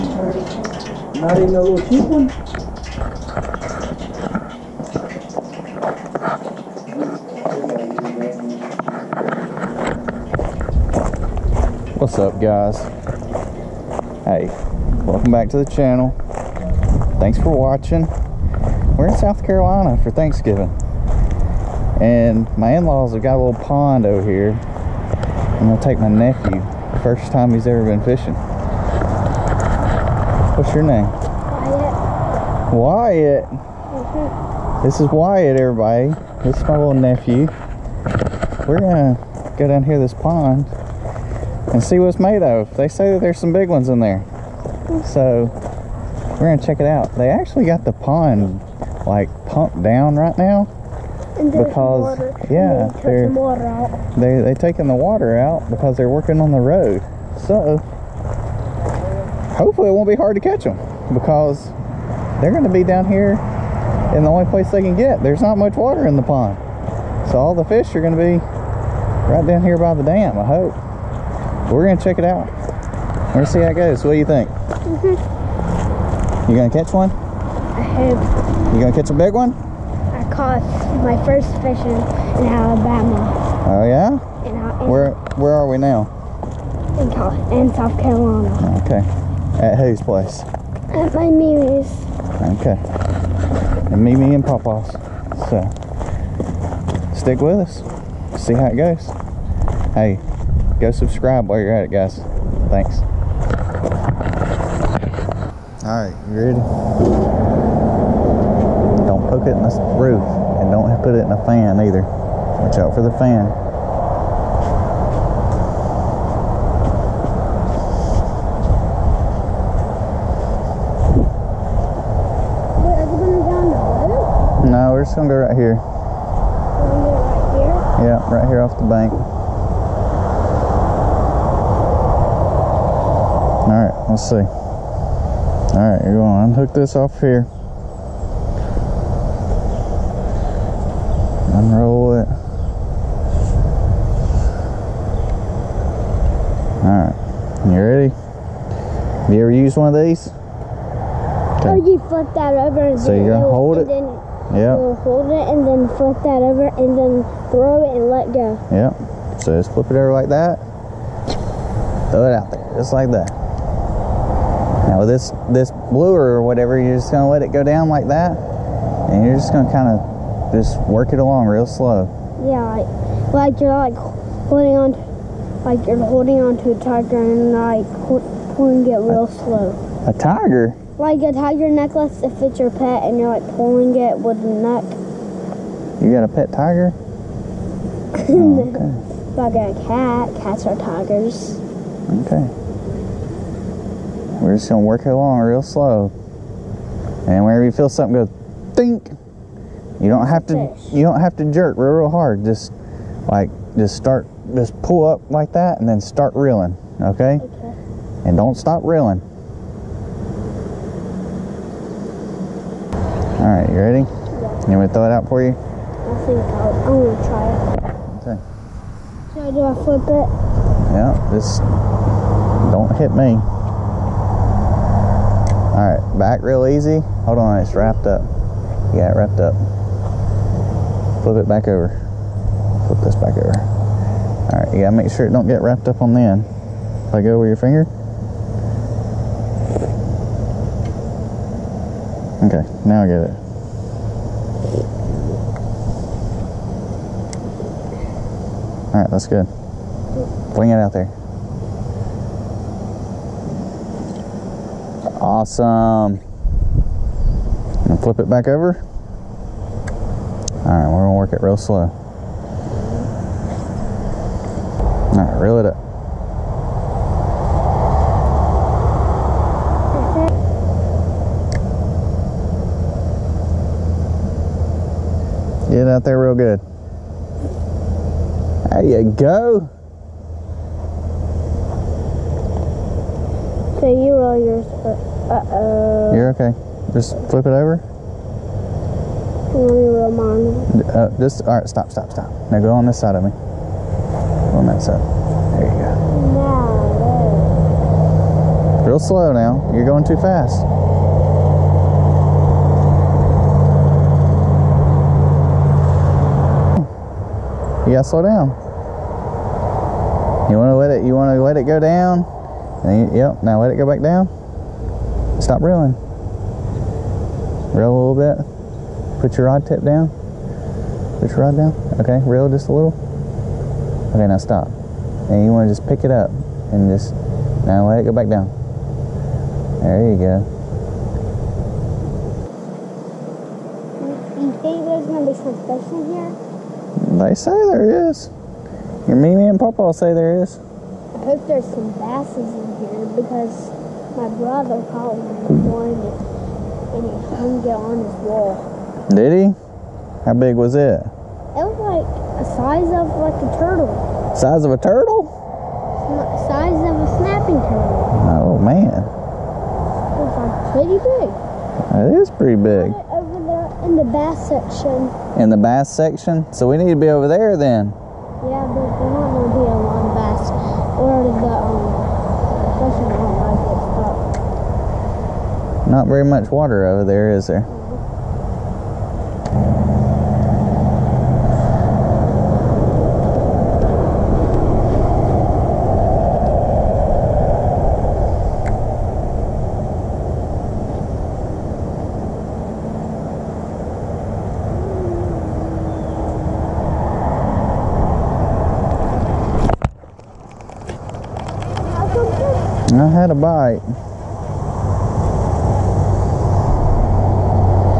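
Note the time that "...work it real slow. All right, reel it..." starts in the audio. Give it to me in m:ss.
4:21.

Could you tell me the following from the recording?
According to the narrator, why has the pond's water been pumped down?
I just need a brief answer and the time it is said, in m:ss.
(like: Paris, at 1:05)
working on the road, at 0:56.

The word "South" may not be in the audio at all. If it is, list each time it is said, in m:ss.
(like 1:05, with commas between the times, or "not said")
0:19, 1:27.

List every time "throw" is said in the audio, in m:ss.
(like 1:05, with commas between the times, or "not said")
2:37, 2:42, 3:34.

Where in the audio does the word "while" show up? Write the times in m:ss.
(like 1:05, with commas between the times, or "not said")
1:41.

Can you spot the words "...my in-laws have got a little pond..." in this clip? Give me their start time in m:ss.
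0:22.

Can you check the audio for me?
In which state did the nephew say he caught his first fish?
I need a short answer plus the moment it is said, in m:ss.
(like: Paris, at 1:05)
Alabama, at 1:22.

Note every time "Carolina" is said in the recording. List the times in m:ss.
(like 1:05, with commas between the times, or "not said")
0:19, 1:27.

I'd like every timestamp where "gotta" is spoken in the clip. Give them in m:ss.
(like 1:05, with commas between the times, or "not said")
3:54, 5:07.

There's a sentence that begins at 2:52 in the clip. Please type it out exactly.
Yeah, like, like you're like holding on, like you're holding on to a tiger and like popcorn get real a, slow.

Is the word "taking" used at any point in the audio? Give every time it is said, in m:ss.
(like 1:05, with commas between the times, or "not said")
0:54.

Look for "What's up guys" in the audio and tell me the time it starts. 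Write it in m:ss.
0:11.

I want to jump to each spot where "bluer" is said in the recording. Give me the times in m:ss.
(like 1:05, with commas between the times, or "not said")
2:45.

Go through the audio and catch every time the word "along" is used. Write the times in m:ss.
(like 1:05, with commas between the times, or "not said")
2:51, 3:15.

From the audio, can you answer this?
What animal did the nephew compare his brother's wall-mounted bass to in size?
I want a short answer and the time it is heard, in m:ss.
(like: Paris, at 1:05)
Snapping turtle, at 5:57.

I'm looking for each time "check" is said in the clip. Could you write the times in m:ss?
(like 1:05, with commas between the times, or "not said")
0:46, 1:12.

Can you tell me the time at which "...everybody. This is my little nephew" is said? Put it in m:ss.
0:35.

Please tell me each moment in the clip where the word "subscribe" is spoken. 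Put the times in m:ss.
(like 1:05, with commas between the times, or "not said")
1:40.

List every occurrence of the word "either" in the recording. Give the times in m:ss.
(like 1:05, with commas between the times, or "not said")
1:51.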